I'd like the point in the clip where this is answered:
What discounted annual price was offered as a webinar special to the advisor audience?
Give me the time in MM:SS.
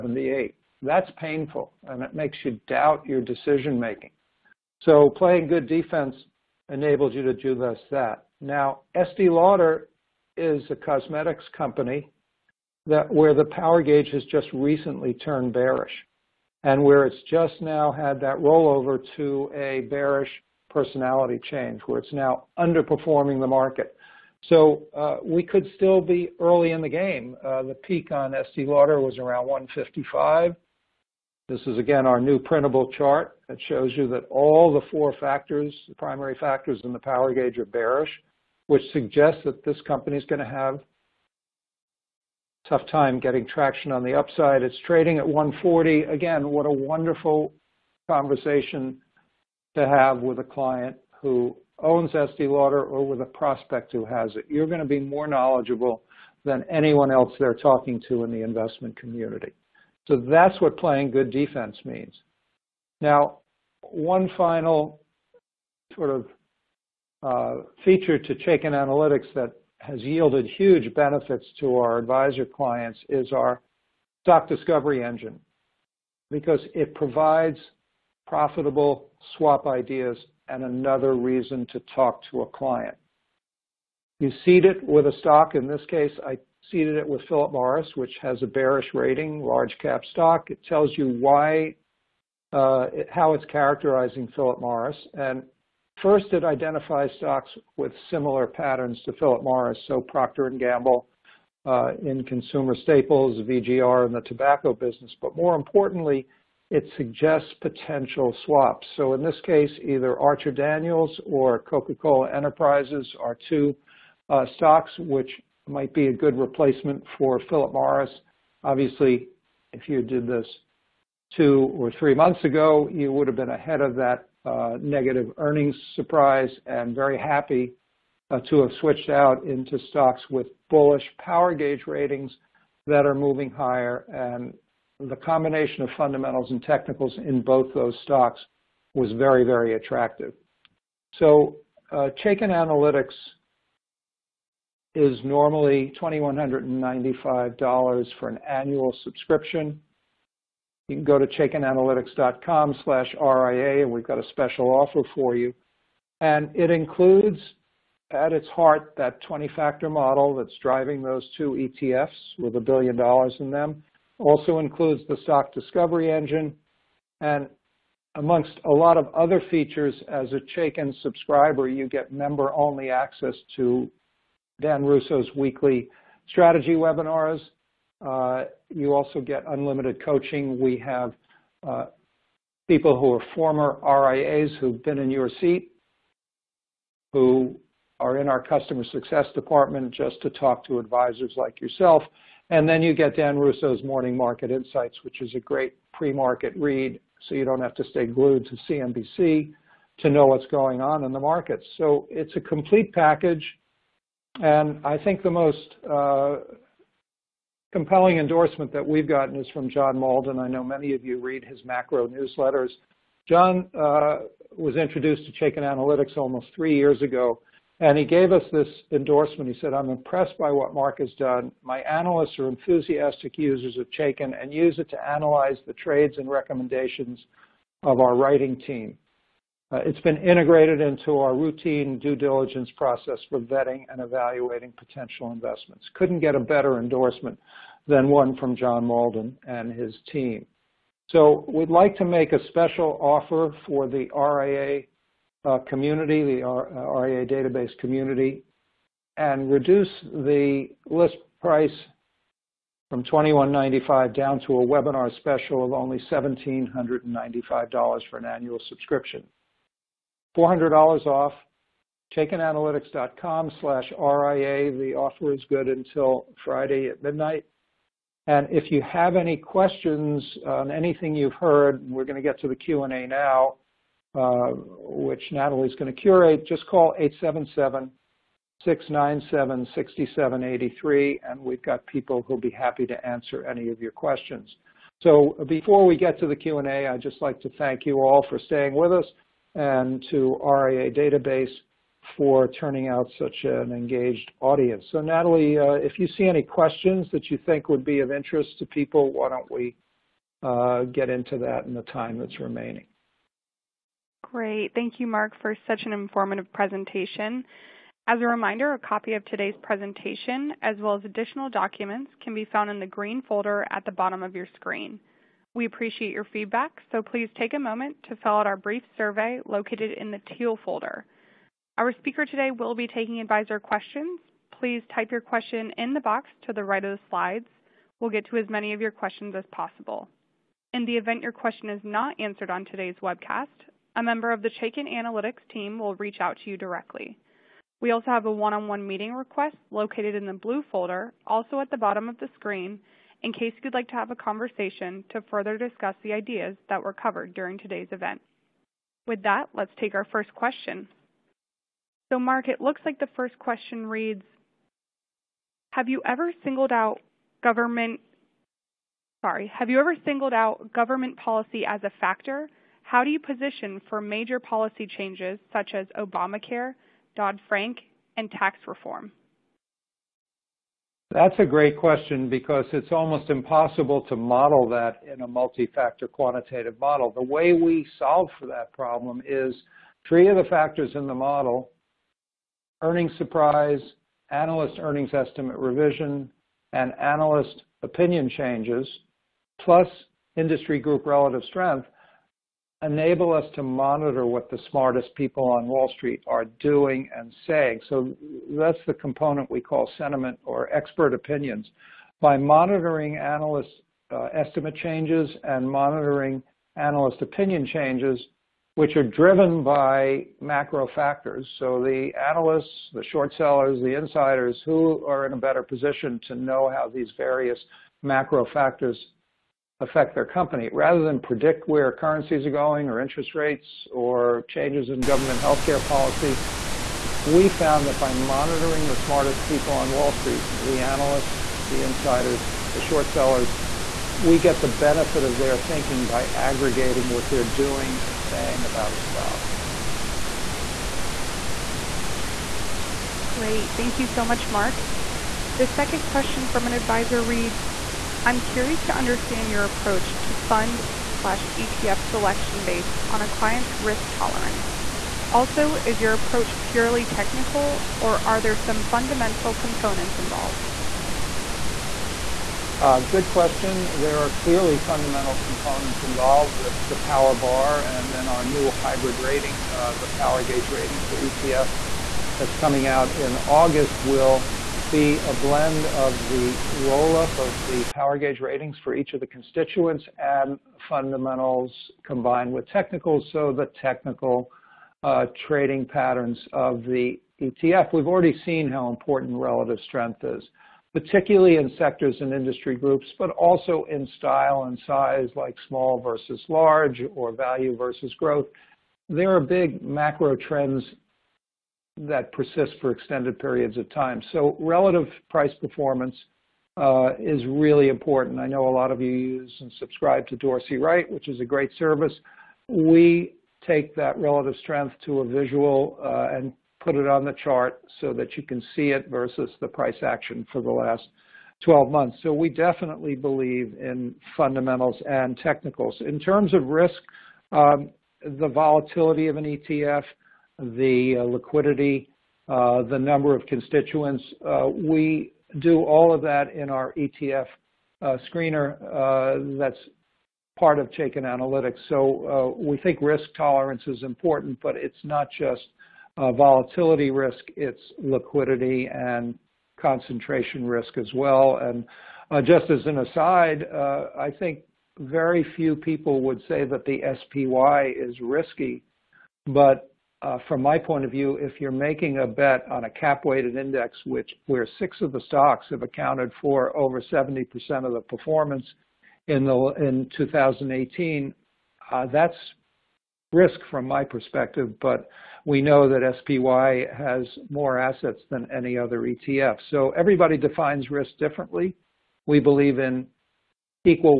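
04:16.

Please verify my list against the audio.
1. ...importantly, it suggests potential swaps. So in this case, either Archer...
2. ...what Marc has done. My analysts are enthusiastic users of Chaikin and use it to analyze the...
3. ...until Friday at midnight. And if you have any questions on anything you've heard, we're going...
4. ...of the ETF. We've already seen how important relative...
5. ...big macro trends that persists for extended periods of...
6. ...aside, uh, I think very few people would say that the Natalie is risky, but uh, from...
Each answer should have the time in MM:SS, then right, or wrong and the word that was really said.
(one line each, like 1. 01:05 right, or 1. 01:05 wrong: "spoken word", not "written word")
1. 01:45 right
2. 03:40 right
3. 04:25 right
4. 08:06 right
5. 08:19 right
6. 09:12 wrong: "SPY", not "Natalie".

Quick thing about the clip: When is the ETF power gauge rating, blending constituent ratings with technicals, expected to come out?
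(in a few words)
August.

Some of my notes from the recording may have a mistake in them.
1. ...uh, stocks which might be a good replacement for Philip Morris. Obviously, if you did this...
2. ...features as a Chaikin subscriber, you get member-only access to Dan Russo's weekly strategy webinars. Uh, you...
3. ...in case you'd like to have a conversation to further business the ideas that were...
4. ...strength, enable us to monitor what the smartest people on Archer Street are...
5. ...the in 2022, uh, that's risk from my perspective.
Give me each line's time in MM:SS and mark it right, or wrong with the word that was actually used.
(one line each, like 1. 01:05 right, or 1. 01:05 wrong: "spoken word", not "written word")
1. 01:54 right
2. 02:49 right
3. 05:43 wrong: "discuss", not "business"
4. 06:31 wrong: "Wall", not "Archer"
5. 09:29 wrong: "2018", not "2022".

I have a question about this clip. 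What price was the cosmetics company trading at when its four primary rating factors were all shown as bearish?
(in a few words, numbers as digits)
140.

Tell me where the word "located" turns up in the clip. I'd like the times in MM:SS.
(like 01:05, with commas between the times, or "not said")
05:19, 05:39.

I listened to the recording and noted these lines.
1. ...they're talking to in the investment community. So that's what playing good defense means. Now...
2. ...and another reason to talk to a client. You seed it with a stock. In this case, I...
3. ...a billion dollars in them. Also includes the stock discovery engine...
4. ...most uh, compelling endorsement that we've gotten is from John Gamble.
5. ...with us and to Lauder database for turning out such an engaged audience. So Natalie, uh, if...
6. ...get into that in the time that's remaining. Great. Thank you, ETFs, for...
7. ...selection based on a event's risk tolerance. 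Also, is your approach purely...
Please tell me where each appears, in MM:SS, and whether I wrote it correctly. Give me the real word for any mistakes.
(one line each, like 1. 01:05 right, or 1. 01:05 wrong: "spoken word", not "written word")
1. 00:57 right
2. 01:20 right
3. 02:42 right
4. 03:25 wrong: "Mauldin", not "Gamble"
5. 04:48 wrong: "RIA", not "Lauder"
6. 05:00 wrong: "Marc", not "ETFs"
7. 07:32 wrong: "client", not "event".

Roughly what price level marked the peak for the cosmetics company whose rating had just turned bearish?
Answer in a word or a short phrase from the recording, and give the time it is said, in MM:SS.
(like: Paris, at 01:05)
155, at 00:29.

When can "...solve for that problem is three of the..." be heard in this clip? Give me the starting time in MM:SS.
06:17.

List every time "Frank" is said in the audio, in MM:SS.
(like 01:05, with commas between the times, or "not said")
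06:07.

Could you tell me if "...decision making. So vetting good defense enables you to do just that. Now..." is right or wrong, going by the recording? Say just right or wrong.
wrong.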